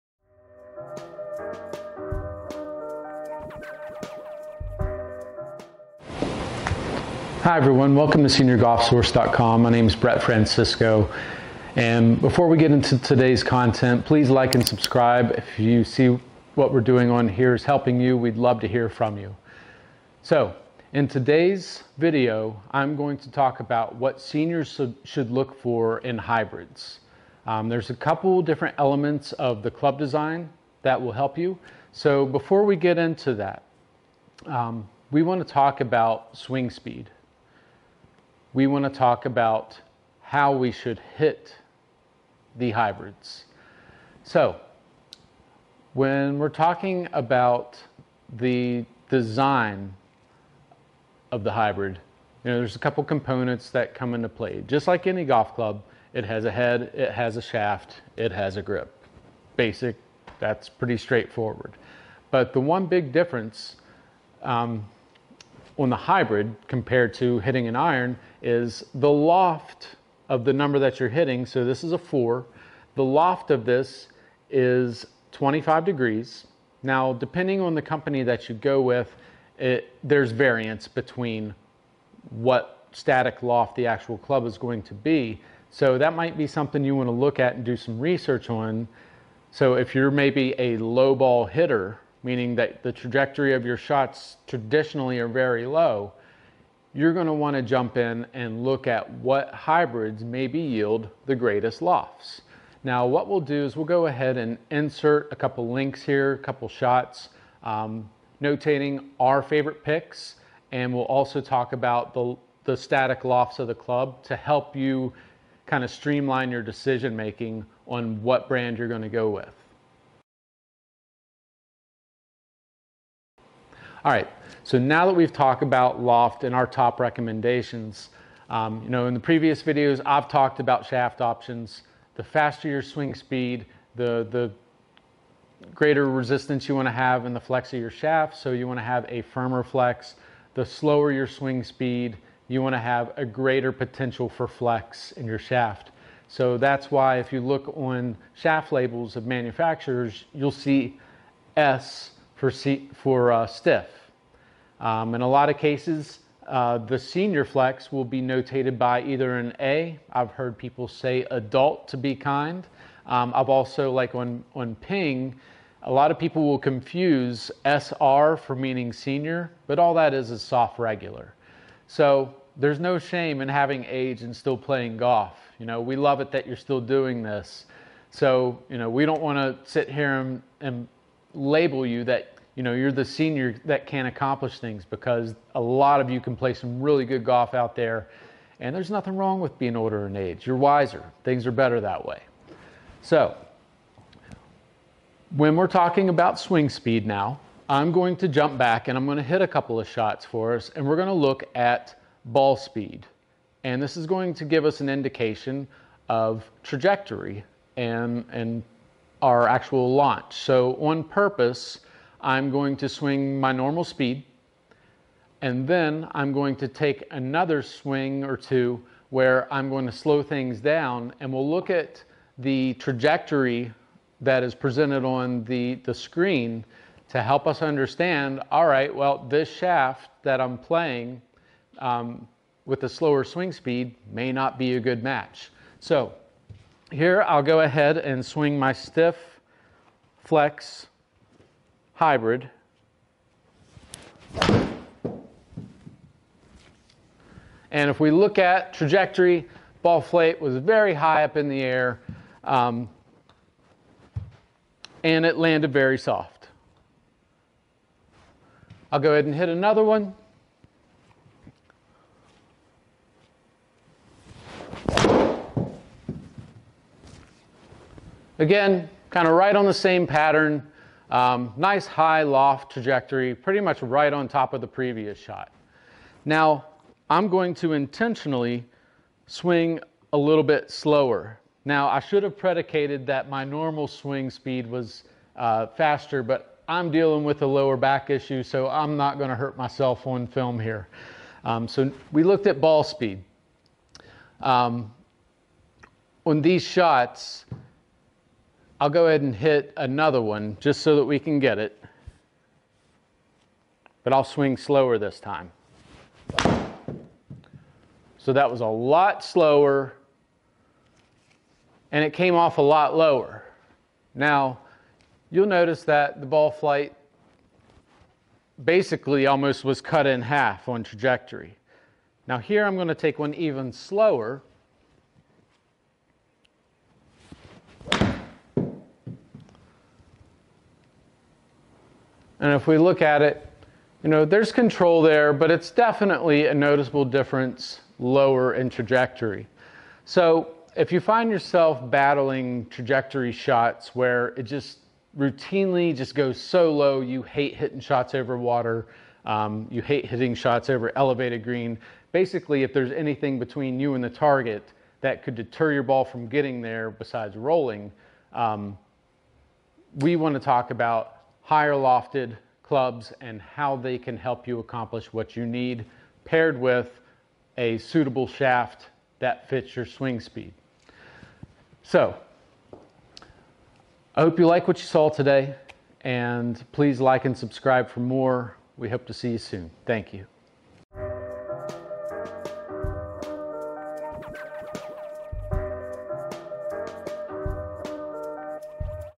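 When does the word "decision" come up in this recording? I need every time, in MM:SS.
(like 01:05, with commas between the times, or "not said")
01:56.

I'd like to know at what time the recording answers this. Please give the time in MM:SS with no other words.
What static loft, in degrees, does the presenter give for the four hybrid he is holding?
01:15.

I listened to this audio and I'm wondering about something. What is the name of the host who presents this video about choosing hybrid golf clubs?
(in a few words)
Brett Francisco.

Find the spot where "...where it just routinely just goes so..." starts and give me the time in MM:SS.
05:43.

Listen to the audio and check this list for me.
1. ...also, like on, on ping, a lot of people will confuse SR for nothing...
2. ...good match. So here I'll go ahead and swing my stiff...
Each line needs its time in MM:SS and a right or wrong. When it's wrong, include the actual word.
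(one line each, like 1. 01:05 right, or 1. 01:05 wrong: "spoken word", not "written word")
1. 02:43 wrong: "meaning", not "nothing"
2. 03:54 right.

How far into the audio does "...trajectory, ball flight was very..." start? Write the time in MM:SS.
04:08.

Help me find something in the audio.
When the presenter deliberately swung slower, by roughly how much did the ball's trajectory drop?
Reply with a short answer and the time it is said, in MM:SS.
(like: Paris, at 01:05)
cut in half, at 05:19.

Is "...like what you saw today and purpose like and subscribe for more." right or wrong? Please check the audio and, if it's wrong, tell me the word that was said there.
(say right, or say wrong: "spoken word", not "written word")
wrong: "please", not "purpose".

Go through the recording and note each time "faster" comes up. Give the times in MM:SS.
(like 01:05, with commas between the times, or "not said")
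02:12, 04:45.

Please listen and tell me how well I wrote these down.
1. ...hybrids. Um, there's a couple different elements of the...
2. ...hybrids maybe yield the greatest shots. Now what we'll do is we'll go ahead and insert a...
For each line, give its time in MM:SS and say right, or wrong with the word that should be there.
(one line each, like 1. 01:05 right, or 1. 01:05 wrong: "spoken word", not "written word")
1. 00:26 right
2. 01:39 wrong: "lofts", not "shots".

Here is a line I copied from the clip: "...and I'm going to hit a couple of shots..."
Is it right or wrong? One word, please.
right.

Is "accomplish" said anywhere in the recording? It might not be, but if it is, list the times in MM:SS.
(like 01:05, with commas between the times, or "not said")
03:04, 06:04.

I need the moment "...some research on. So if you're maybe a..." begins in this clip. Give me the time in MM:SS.
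01:27.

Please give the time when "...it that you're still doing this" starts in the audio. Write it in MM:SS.
02:56.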